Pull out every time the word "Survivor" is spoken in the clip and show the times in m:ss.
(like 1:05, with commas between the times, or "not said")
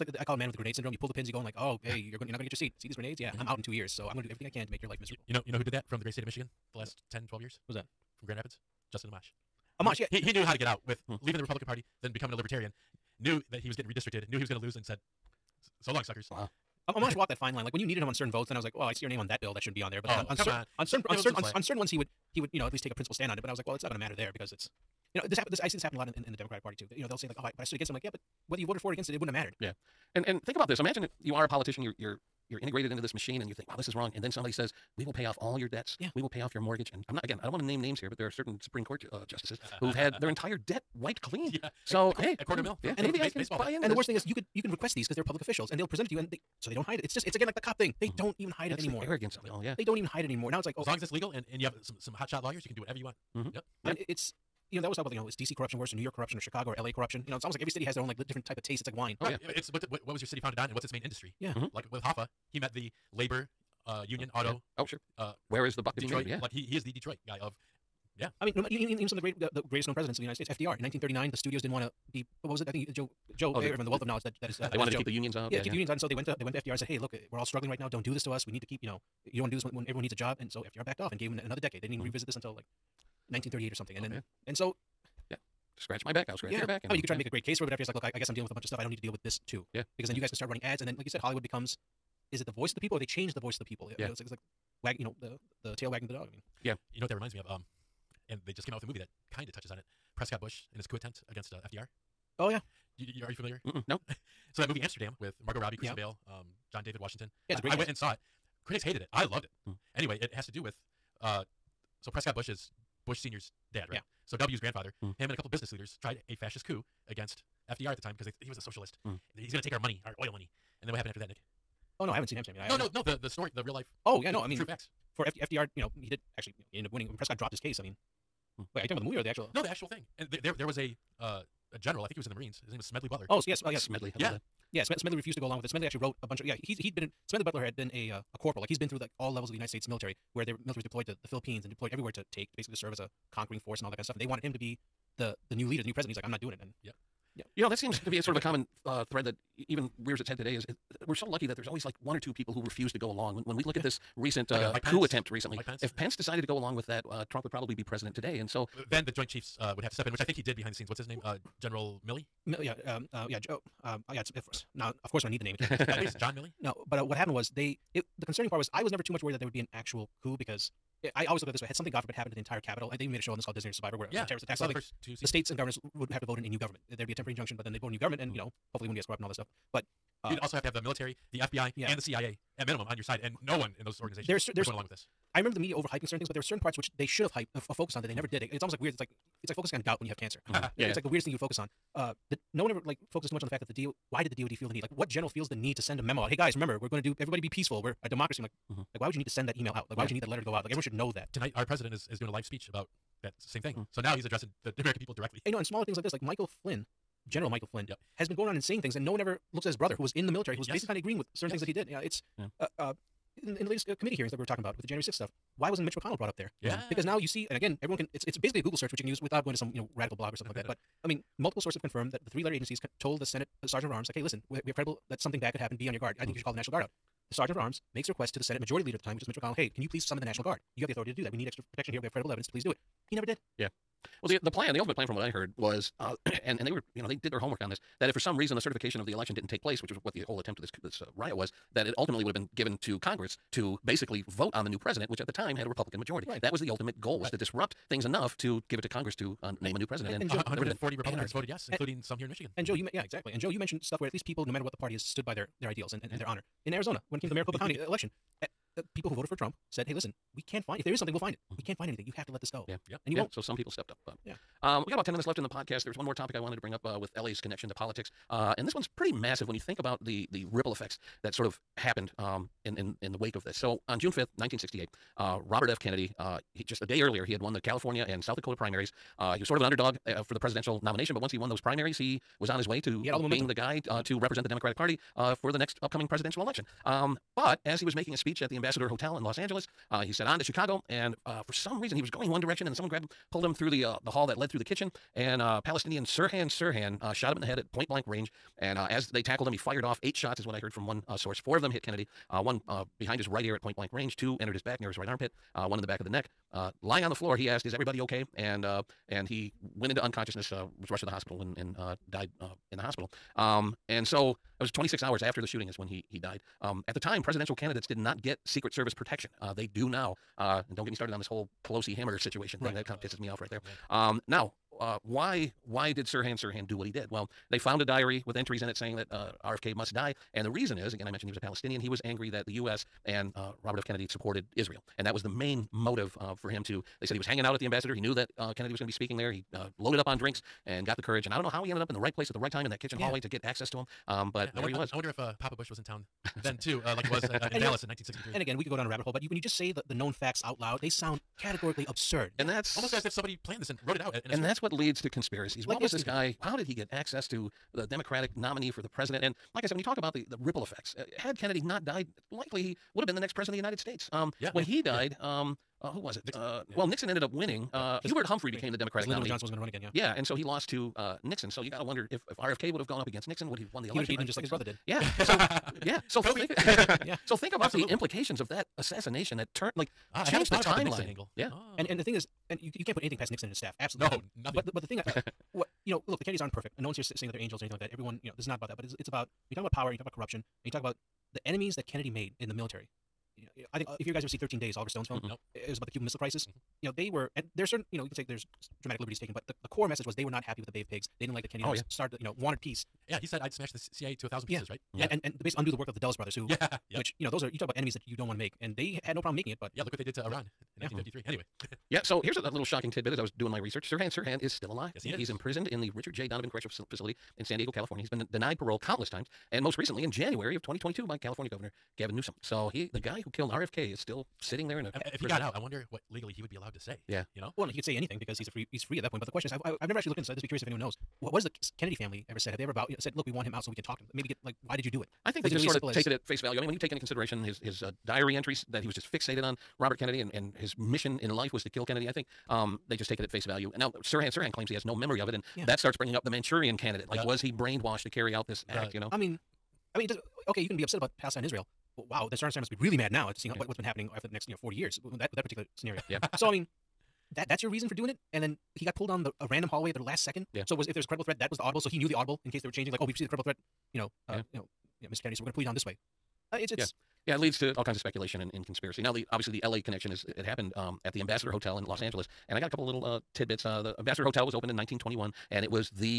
2:53.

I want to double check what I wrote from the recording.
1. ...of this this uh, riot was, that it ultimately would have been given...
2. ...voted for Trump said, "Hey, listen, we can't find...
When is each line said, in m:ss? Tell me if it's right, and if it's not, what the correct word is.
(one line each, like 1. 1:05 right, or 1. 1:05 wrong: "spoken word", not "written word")
1. 4:00 right
2. 4:19 right.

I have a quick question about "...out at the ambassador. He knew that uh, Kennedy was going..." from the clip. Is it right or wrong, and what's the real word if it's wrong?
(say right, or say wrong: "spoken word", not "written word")
right.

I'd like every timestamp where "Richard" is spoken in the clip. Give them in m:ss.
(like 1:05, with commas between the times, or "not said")
6:55.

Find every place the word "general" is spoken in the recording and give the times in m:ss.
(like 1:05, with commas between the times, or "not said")
2:11, 2:41, 3:15, 3:27.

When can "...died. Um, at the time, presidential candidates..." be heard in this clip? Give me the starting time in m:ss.
5:16.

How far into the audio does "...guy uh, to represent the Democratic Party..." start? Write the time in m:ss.
4:43.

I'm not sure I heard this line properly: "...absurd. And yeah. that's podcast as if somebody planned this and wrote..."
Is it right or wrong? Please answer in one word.
wrong.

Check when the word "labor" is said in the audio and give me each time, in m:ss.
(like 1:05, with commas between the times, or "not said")
1:03.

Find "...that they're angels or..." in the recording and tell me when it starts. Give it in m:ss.
6:27.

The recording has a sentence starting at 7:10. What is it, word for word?
I'd just be curious if anyone knows.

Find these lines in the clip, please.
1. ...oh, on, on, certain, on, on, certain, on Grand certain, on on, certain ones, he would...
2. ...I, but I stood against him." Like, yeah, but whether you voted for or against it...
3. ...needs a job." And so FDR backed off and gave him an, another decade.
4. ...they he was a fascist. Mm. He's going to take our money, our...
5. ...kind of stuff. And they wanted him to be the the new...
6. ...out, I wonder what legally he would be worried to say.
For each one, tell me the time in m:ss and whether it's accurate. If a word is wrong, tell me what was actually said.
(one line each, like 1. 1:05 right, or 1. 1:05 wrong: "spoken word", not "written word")
1. 0:20 wrong: "Give", not "Grand"
2. 0:27 right
3. 1:20 right
4. 1:58 wrong: "socialist", not "fascist"
5. 2:23 right
6. 7:05 wrong: "allowed", not "worried".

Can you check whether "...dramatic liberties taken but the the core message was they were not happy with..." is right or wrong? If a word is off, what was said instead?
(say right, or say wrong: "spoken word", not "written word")
right.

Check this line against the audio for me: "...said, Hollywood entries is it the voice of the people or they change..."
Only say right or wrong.
wrong.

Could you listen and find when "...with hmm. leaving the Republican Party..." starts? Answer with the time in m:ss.
0:10.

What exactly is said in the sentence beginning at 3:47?
The sergeant at arms makes a request to the Senate Majority Leader at the time, which is Mitch McConnell.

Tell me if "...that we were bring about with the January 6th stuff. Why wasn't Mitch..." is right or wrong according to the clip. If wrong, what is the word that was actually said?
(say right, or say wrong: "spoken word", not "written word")
wrong: "talking", not "bring".